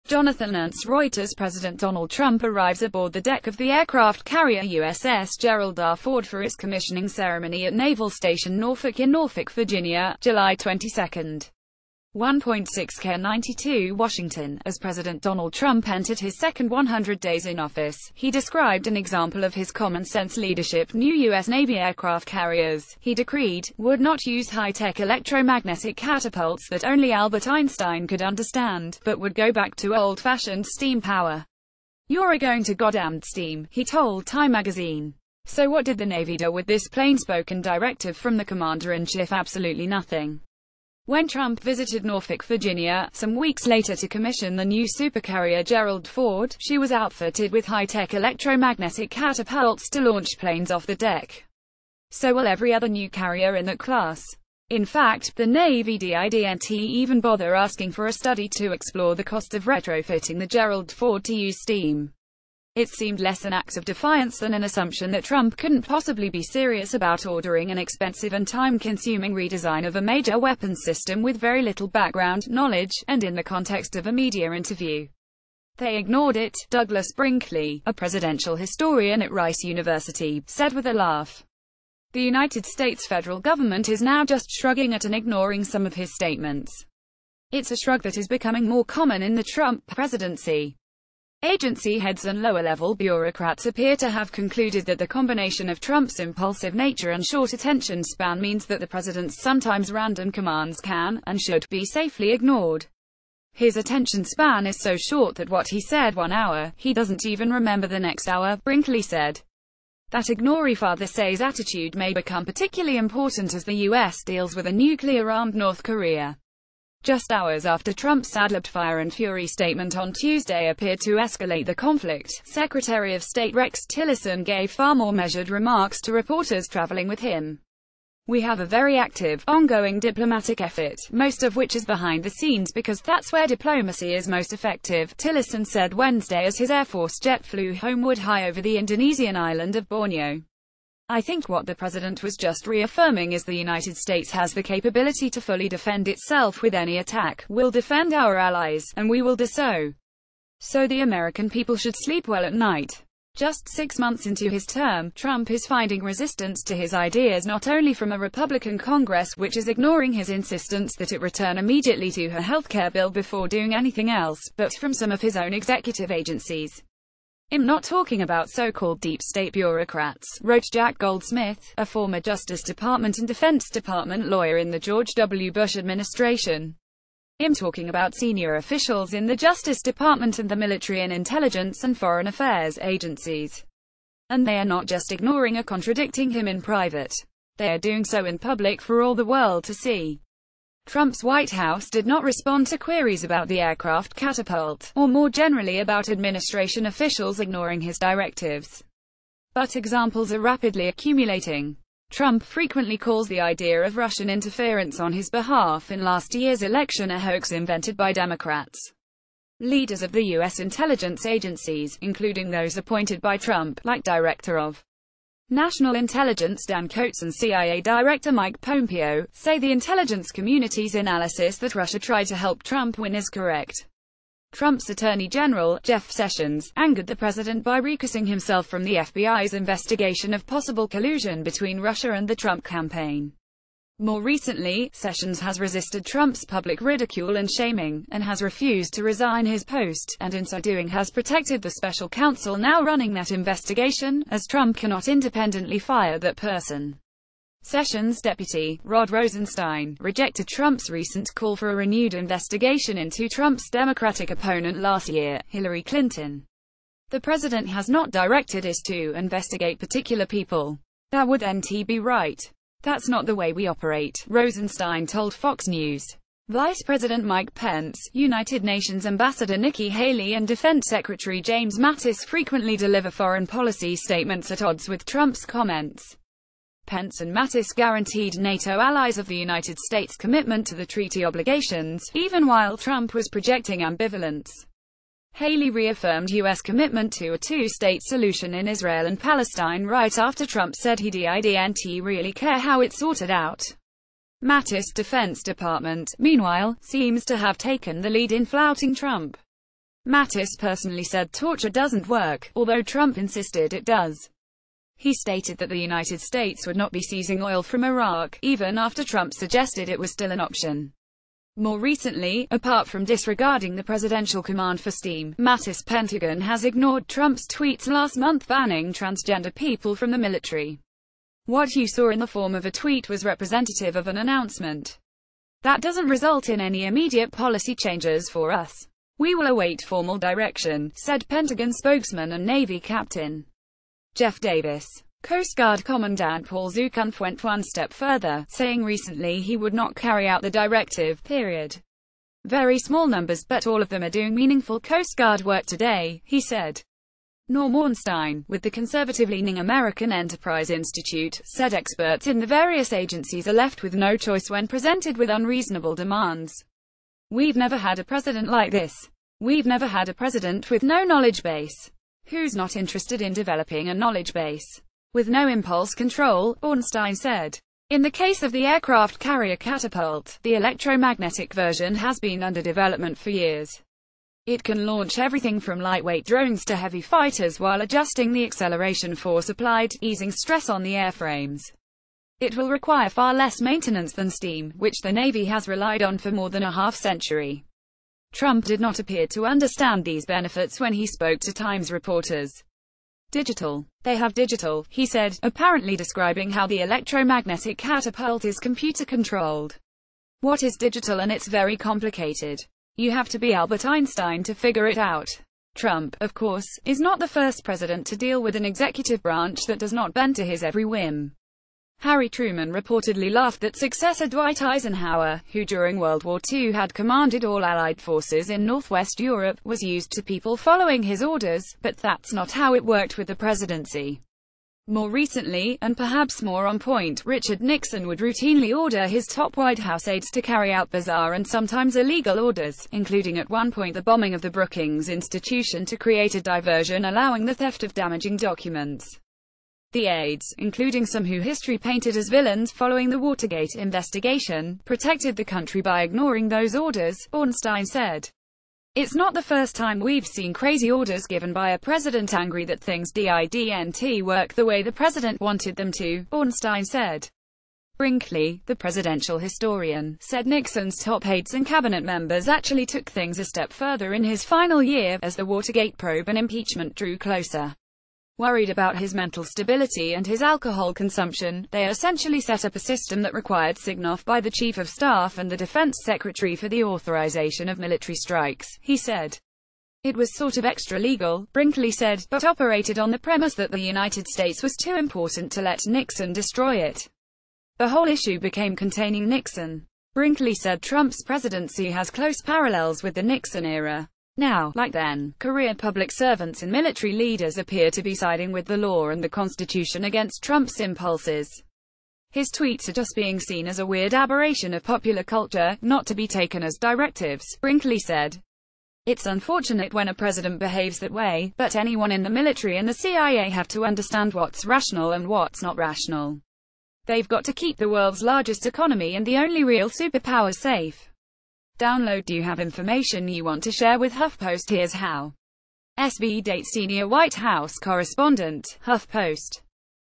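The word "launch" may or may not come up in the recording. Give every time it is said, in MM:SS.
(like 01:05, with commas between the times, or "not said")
00:49, 06:14.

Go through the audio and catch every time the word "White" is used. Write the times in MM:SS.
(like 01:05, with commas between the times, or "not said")
03:11, 07:09, 08:47.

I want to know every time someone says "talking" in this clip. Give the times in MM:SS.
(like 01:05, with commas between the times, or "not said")
02:47, 02:57.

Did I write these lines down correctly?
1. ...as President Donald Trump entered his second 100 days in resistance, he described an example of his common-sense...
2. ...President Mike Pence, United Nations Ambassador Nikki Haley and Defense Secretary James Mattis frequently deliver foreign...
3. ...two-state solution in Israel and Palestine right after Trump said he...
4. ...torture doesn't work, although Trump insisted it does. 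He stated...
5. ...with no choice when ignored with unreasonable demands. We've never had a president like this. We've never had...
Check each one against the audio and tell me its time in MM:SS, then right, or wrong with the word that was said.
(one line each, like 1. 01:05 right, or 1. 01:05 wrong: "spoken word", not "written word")
1. 00:14 wrong: "office", not "resistance"
2. 04:26 right
3. 04:47 right
4. 05:01 right
5. 05:53 wrong: "presented", not "ignored".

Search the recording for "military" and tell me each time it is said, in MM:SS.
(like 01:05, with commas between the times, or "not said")
03:00, 05:20, 07:57, 08:16, 08:32.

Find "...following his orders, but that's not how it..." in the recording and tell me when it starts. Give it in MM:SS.
07:00.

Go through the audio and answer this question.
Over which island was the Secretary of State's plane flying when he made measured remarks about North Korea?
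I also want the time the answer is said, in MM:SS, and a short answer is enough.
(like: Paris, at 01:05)
Borneo, at 02:19.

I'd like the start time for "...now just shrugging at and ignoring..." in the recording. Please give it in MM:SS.
01:24.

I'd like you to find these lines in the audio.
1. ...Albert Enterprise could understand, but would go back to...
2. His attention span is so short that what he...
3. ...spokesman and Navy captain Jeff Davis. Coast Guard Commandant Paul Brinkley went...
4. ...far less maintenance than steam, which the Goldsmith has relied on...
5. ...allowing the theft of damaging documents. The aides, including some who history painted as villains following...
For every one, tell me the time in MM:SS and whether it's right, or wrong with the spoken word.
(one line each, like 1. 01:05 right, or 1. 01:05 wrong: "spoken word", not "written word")
1. 00:27 wrong: "Einstein", not "Enterprise"
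2. 01:43 right
3. 05:31 wrong: "Zukunft", not "Brinkley"
4. 06:23 wrong: "Navy", not "Goldsmith"
5. 07:17 right.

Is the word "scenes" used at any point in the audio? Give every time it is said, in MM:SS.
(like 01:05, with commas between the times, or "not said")
02:12.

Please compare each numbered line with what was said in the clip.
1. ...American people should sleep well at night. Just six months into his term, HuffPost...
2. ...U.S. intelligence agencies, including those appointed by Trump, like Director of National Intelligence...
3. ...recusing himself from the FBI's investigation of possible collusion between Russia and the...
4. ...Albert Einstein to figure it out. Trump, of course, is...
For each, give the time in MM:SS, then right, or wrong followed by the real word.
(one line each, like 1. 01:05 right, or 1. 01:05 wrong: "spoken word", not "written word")
1. 02:31 wrong: "Trump", not "HuffPost"
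2. 03:30 right
3. 03:47 right
4. 06:43 right.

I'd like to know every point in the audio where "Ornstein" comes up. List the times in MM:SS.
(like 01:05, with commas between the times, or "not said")
05:47, 06:06, 07:27, 07:36.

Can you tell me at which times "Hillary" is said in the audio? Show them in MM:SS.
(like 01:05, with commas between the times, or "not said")
04:15.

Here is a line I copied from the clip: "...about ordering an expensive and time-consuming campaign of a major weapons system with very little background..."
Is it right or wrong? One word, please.
wrong.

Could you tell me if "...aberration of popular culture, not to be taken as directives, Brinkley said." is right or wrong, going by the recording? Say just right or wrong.
right.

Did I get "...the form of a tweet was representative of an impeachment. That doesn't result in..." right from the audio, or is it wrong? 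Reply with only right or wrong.
wrong.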